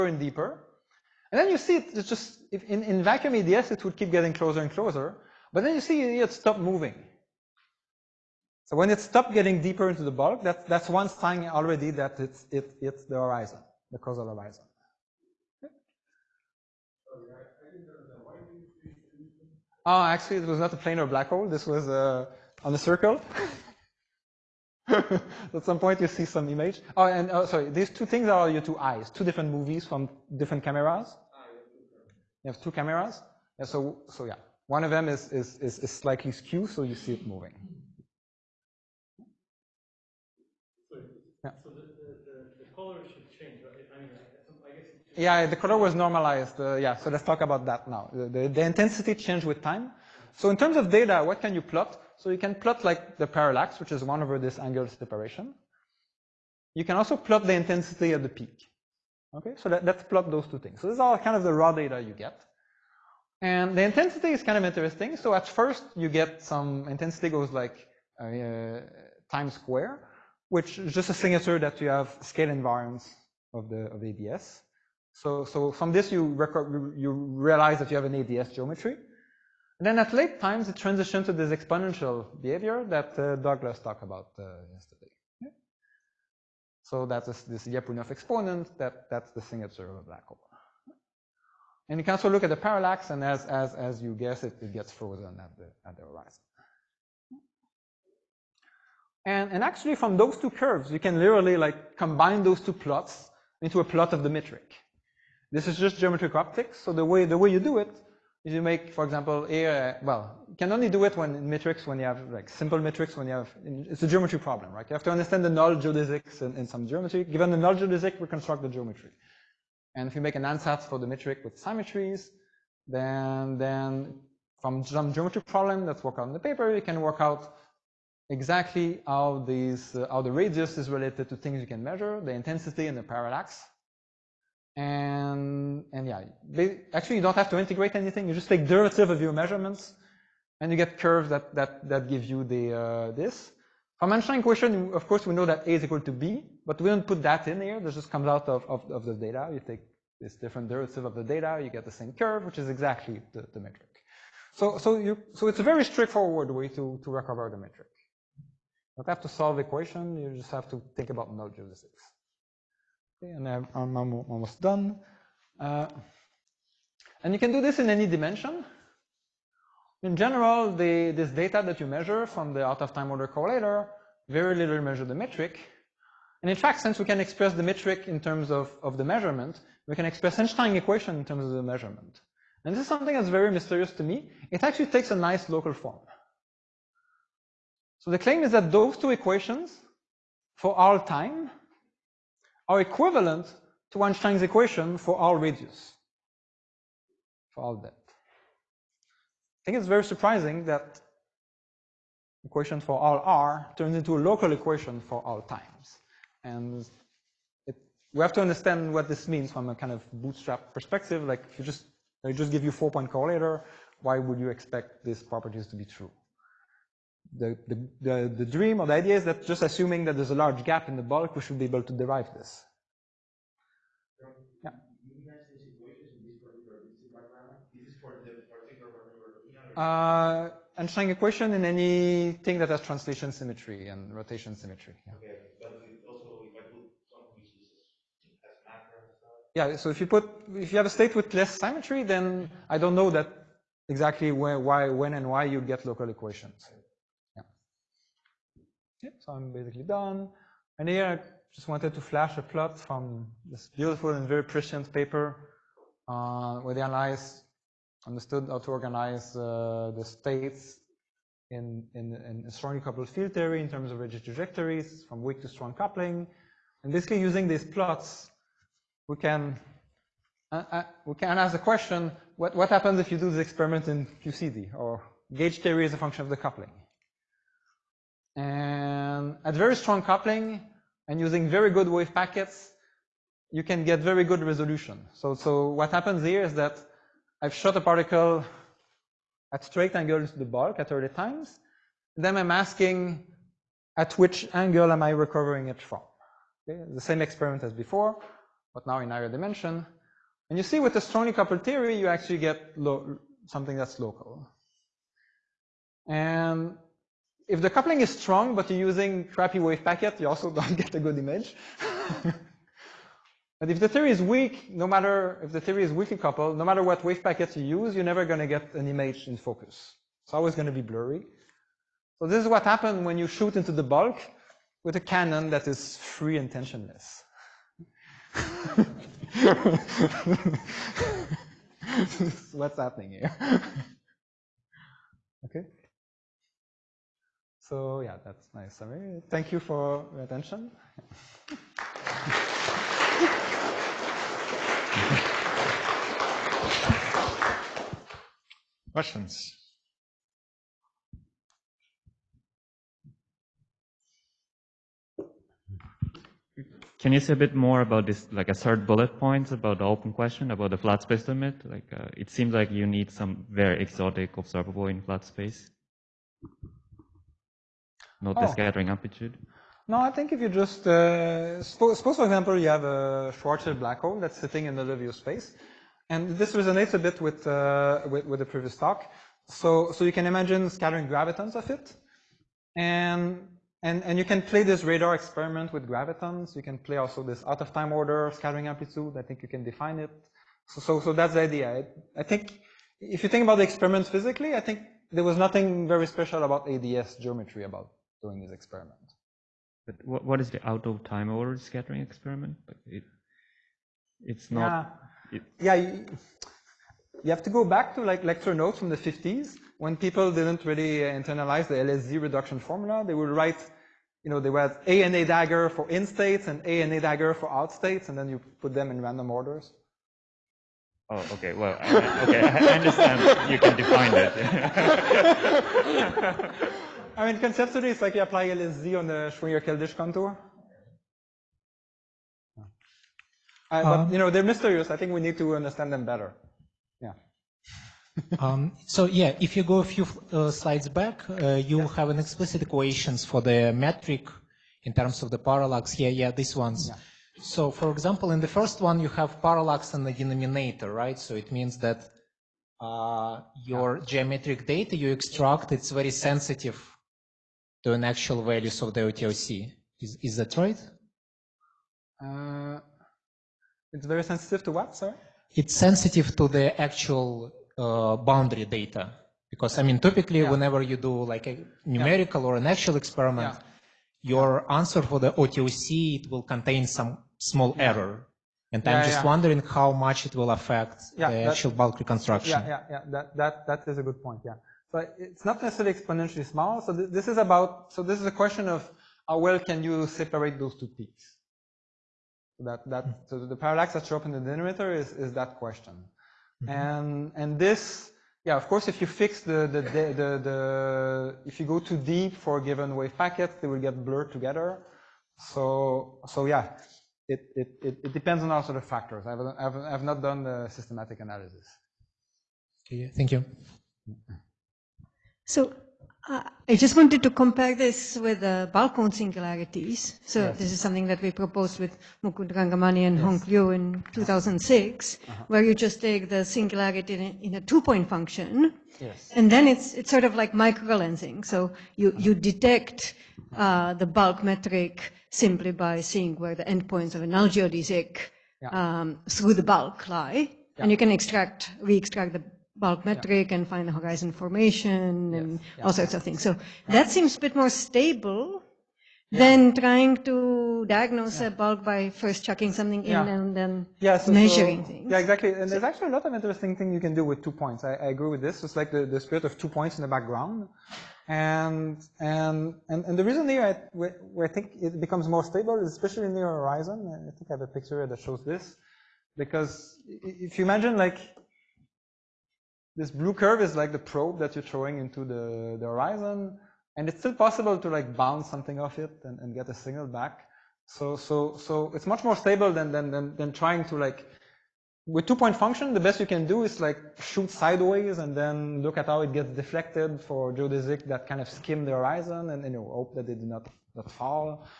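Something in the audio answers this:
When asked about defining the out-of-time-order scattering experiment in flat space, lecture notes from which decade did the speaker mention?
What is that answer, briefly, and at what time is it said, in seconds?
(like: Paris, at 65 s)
The 1950s, at 408 s.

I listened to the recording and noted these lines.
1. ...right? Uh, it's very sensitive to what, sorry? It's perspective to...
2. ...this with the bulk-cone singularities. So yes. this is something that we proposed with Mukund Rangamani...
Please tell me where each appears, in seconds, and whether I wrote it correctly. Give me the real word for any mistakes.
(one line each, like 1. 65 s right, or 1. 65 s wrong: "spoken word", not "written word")
1. 460 s wrong: "sensitive", not "perspective"
2. 517 s right.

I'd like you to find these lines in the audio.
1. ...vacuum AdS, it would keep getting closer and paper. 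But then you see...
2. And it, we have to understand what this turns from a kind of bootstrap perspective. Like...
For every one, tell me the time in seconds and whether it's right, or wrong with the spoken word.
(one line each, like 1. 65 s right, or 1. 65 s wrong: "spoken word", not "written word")
1. 3 s wrong: "closer", not "paper"
2. 206 s wrong: "means", not "turns".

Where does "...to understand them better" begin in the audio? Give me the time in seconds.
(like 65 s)
435 s.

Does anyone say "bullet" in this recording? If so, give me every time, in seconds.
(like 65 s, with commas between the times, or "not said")
358 s.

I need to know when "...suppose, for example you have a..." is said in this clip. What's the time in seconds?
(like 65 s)
371 s.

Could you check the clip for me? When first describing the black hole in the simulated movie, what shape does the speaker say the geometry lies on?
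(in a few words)
A circle.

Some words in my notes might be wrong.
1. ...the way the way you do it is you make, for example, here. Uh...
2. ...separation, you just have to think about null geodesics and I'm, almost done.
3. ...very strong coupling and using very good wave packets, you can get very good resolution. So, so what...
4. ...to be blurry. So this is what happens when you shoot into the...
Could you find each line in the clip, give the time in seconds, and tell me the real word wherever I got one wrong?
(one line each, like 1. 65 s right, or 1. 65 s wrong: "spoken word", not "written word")
1. 107 s right
2. 159 s wrong: "equation", not "separation"
3. 279 s right
4. 320 s right.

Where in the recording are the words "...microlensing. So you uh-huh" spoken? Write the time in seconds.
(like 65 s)
530 s.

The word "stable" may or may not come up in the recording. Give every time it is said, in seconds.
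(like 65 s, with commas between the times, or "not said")
547 s, 565 s, 582 s.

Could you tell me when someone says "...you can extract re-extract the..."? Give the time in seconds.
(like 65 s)
540 s.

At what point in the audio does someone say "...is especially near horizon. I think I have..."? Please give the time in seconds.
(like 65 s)
565 s.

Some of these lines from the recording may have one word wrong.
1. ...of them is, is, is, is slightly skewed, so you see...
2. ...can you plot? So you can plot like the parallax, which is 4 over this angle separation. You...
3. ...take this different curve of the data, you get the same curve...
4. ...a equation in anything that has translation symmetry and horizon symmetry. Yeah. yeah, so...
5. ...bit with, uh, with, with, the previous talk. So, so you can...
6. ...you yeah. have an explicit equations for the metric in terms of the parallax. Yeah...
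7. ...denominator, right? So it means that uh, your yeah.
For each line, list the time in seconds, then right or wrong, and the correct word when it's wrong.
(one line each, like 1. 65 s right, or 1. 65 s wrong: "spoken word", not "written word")
1. 34 s right
2. 51 s wrong: "1", not "4"
3. 149 s wrong: "derivative", not "curve"
4. 230 s wrong: "rotation", not "horizon"
5. 376 s right
6. 441 s right
7. 450 s right.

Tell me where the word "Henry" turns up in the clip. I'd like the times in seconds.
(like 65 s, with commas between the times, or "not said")
not said.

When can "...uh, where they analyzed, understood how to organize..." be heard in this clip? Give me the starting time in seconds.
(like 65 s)
256 s.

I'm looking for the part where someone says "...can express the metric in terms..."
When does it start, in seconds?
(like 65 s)
177 s.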